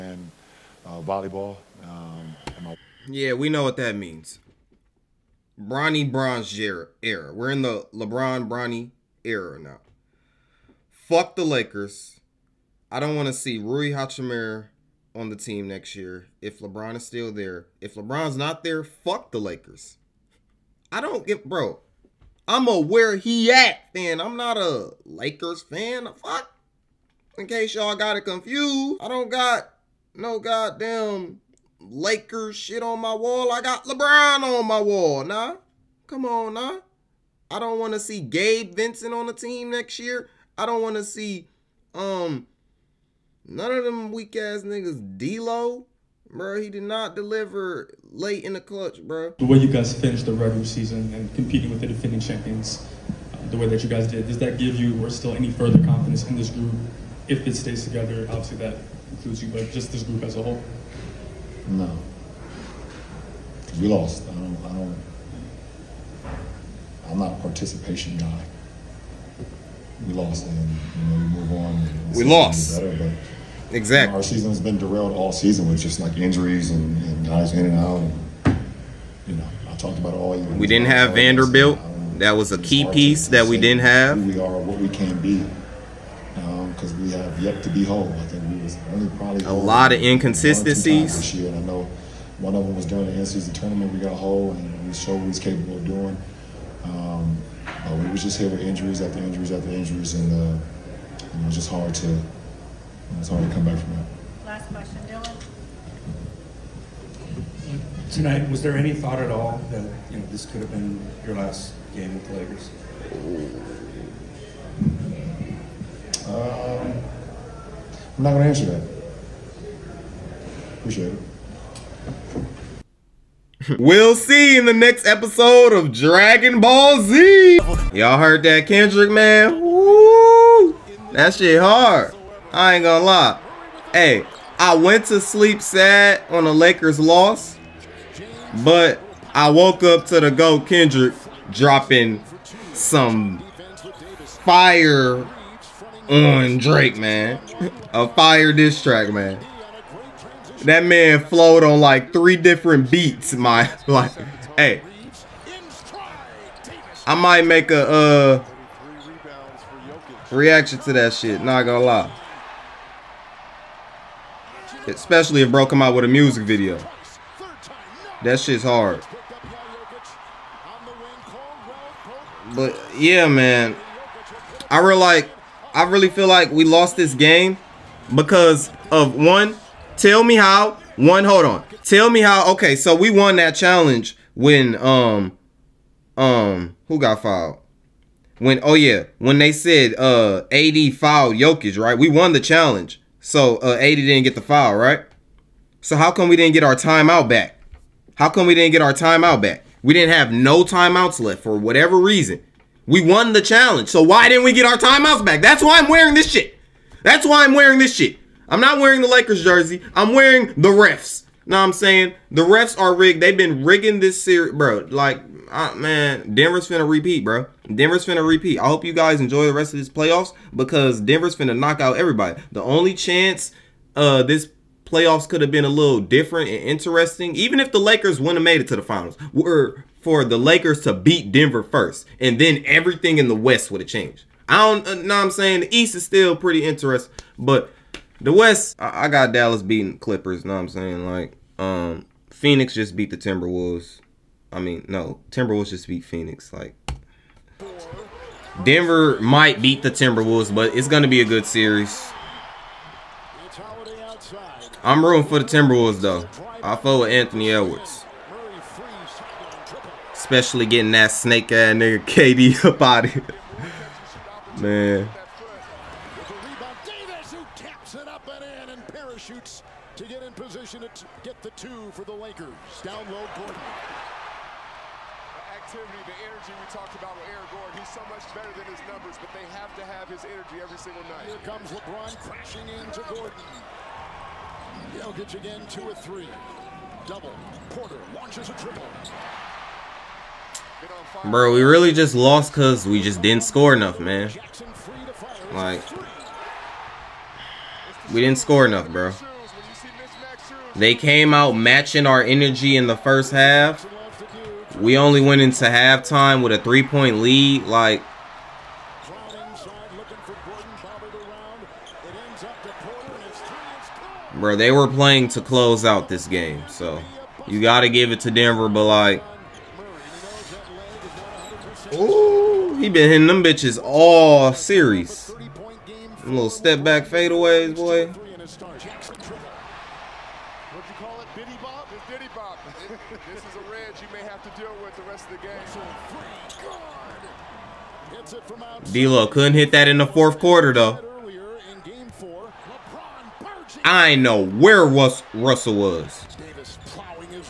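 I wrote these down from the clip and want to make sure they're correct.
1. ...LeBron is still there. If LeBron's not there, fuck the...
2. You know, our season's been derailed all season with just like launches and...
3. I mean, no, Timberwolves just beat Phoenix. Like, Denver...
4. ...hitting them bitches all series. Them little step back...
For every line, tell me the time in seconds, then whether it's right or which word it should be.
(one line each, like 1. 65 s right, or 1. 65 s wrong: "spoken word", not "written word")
1. 16 s right
2. 74 s wrong: "injuries", not "launches"
3. 244 s right
4. 323 s right.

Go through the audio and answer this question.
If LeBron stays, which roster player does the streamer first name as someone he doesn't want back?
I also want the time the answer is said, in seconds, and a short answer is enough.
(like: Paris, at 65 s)
Rui Hachimura, at 13 s.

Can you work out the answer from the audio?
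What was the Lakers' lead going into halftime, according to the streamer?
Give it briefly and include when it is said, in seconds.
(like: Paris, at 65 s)
3 points, at 306 s.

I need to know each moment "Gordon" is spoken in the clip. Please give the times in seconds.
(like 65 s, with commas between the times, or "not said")
273 s, 277 s, 283 s.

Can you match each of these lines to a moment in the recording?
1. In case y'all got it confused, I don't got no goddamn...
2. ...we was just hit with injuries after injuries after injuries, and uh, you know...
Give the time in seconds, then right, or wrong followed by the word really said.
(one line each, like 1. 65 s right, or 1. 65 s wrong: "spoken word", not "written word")
1. 27 s right
2. 97 s right.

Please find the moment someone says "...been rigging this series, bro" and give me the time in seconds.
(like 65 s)
213 s.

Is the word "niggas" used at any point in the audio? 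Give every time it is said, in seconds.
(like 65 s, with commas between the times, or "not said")
44 s, 261 s.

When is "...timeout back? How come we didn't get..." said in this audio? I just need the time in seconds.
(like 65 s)
196 s.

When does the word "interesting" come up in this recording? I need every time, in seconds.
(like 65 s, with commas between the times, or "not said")
226 s, 236 s.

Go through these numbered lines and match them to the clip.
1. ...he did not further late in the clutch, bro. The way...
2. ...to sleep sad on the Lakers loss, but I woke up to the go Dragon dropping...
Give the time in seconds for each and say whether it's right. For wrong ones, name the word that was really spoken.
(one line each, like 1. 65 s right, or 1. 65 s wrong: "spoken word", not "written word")
1. 46 s wrong: "deliver", not "further"
2. 135 s wrong: "Kendrick", not "Dragon".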